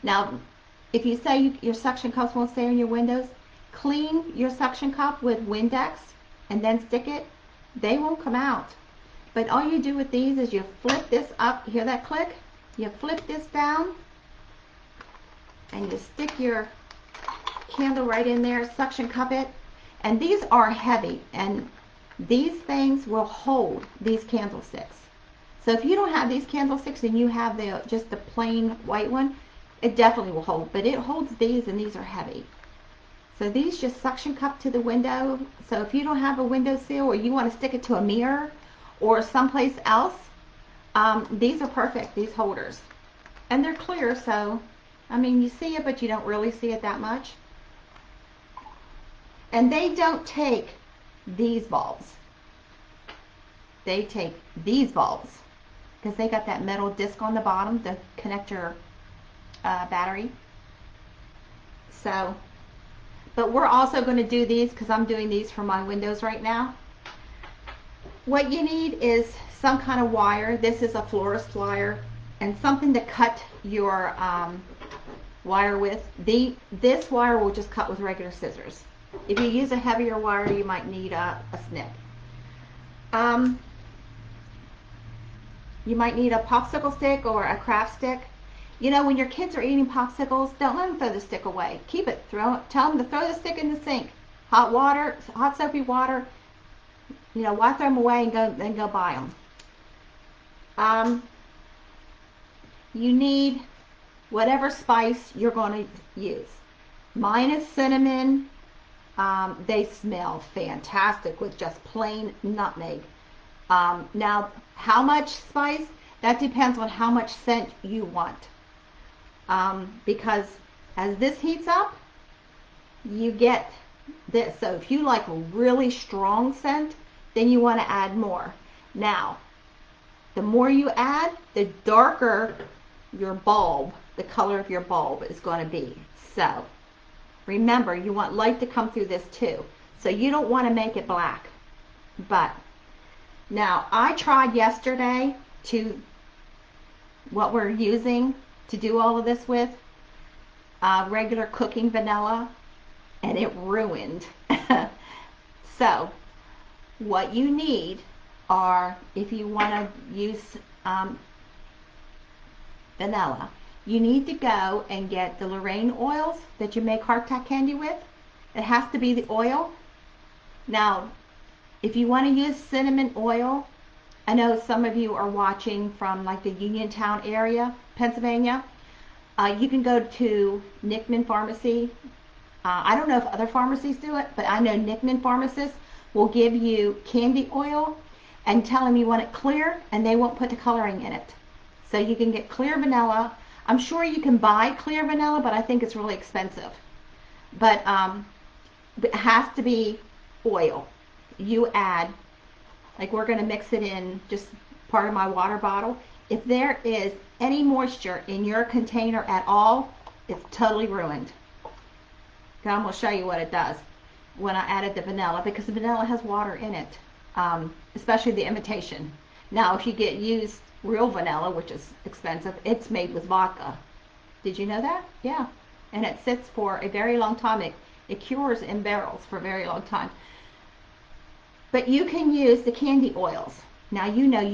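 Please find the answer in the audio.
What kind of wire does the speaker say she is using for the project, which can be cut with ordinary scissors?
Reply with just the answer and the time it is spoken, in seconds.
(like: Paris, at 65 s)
florist wire, at 71 s.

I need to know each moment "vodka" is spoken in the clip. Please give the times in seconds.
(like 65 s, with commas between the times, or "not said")
223 s.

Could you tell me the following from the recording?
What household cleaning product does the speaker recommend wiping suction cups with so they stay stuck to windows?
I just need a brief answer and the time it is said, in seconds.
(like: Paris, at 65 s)
Windex, at 5 s.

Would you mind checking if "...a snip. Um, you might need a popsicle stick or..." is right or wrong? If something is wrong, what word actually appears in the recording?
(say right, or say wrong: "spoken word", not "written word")
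right.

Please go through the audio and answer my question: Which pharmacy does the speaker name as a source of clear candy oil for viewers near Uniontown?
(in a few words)
Nickman Pharmacy.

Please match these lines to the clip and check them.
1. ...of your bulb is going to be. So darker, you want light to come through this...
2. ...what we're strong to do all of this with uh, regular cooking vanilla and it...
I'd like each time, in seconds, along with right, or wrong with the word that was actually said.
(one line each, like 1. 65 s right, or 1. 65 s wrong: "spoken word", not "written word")
1. 134 s wrong: "remember", not "darker"
2. 147 s wrong: "using", not "strong".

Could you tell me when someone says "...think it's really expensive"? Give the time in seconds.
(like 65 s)
195 s.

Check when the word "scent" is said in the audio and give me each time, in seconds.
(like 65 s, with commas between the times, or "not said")
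117 s, 126 s.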